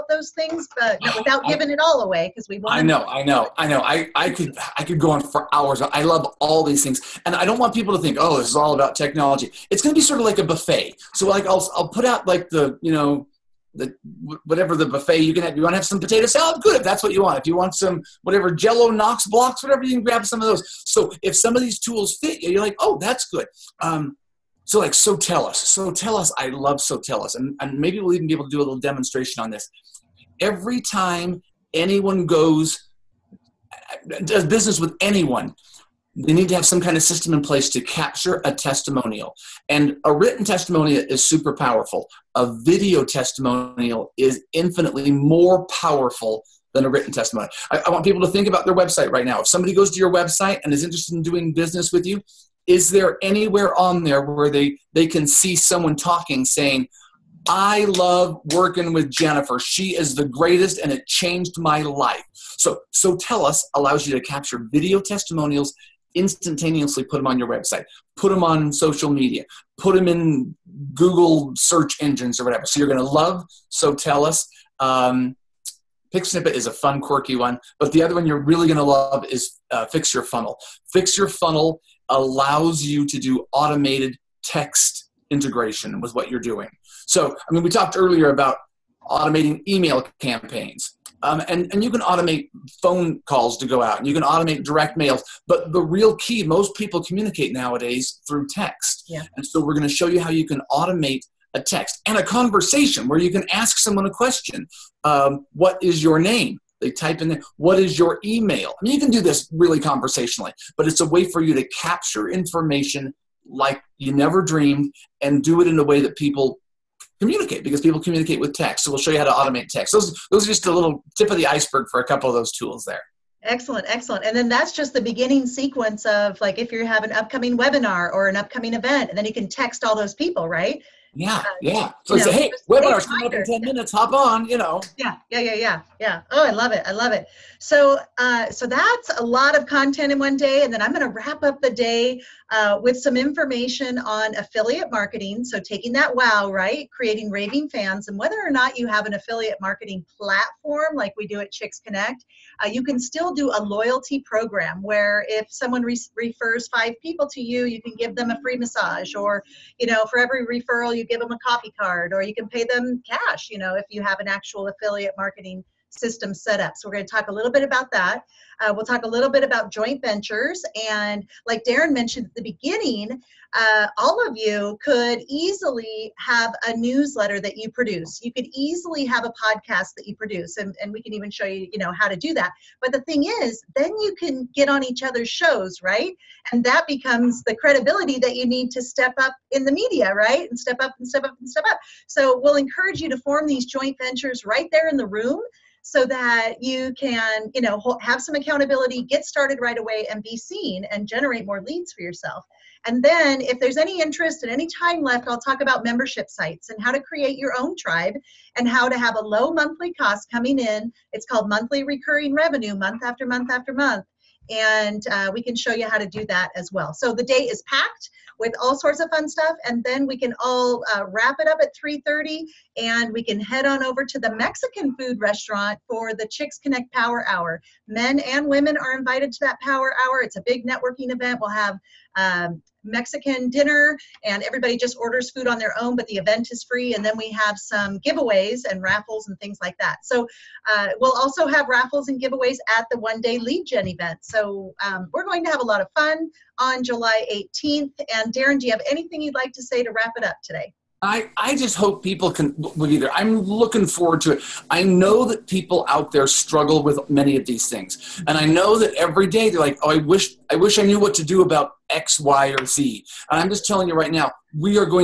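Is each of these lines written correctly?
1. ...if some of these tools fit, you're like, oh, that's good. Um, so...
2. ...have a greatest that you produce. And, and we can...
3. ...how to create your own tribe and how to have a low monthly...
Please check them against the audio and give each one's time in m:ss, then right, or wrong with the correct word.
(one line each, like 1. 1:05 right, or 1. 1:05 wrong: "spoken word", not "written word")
1. 0:21 right
2. 2:59 wrong: "podcast", not "greatest"
3. 3:26 right.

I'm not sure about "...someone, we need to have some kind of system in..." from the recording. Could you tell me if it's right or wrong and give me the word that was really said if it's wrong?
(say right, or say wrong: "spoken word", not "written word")
wrong: "anyone", not "someone".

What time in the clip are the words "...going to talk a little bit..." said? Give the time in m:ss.
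2:46.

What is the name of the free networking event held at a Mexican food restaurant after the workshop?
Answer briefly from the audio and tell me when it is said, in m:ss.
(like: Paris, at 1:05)
Chicks Connect Power Hour, at 3:46.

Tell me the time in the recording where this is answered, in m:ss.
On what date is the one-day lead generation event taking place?
4:06.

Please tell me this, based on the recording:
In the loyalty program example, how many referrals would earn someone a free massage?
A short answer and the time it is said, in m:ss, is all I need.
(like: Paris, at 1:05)
5, at 2:36.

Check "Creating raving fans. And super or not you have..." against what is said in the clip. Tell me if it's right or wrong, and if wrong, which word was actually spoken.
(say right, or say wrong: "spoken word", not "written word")
wrong: "whether", not "super".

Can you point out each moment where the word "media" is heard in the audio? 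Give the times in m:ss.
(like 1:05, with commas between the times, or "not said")
1:09, 3:09.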